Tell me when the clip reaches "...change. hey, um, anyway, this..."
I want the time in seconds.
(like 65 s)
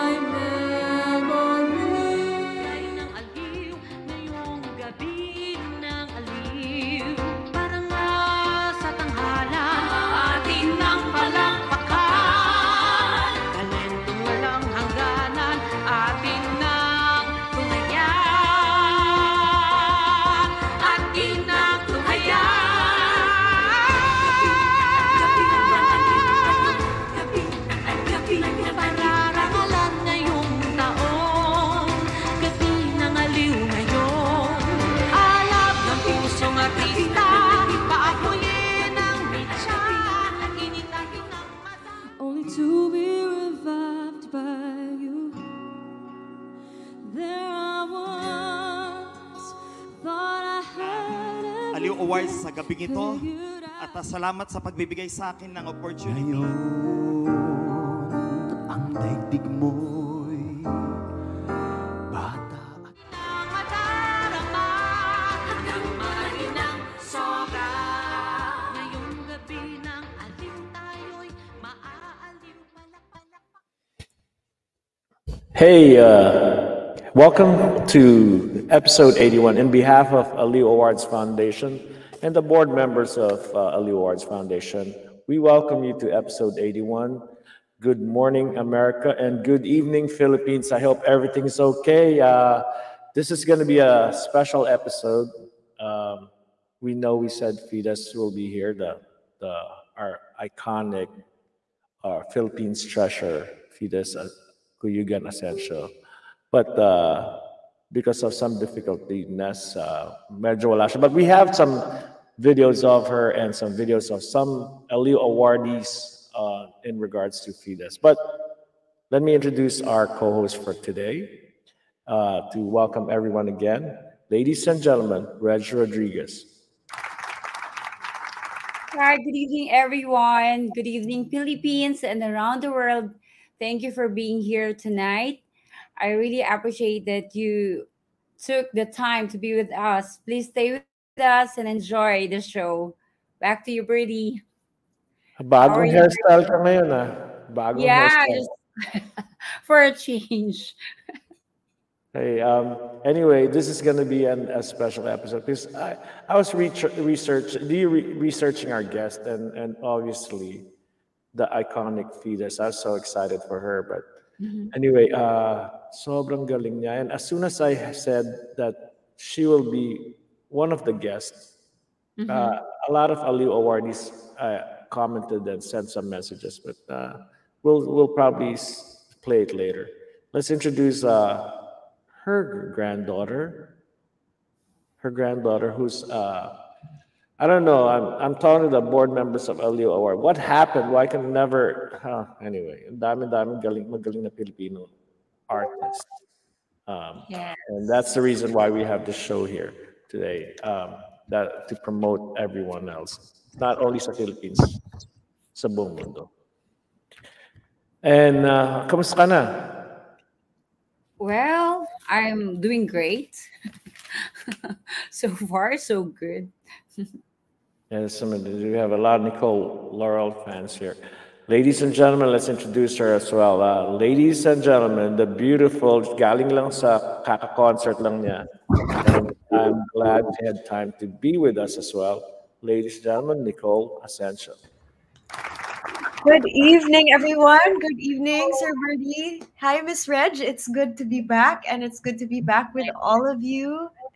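149 s.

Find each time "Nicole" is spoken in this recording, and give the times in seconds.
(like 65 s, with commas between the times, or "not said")
219 s, 233 s.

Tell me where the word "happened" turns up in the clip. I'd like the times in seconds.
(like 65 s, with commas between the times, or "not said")
190 s.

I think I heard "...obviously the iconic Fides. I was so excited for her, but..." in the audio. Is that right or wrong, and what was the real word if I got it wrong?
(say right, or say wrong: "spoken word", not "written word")
right.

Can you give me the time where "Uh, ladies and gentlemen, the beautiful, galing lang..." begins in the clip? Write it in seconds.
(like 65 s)
223 s.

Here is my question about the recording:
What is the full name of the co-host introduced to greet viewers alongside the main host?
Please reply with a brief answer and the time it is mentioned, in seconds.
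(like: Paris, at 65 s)
Reg Rodriguez, at 125 s.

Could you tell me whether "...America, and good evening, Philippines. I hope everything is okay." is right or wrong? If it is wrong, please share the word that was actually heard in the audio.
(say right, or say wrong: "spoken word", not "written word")
right.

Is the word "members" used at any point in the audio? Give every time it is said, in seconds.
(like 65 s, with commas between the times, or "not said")
82 s, 189 s.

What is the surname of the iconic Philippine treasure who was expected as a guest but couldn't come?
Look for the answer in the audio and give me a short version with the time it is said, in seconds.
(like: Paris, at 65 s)
Cuyugan Asensio, at 104 s.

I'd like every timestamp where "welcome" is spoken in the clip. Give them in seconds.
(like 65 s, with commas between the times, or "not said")
77 s, 85 s, 122 s.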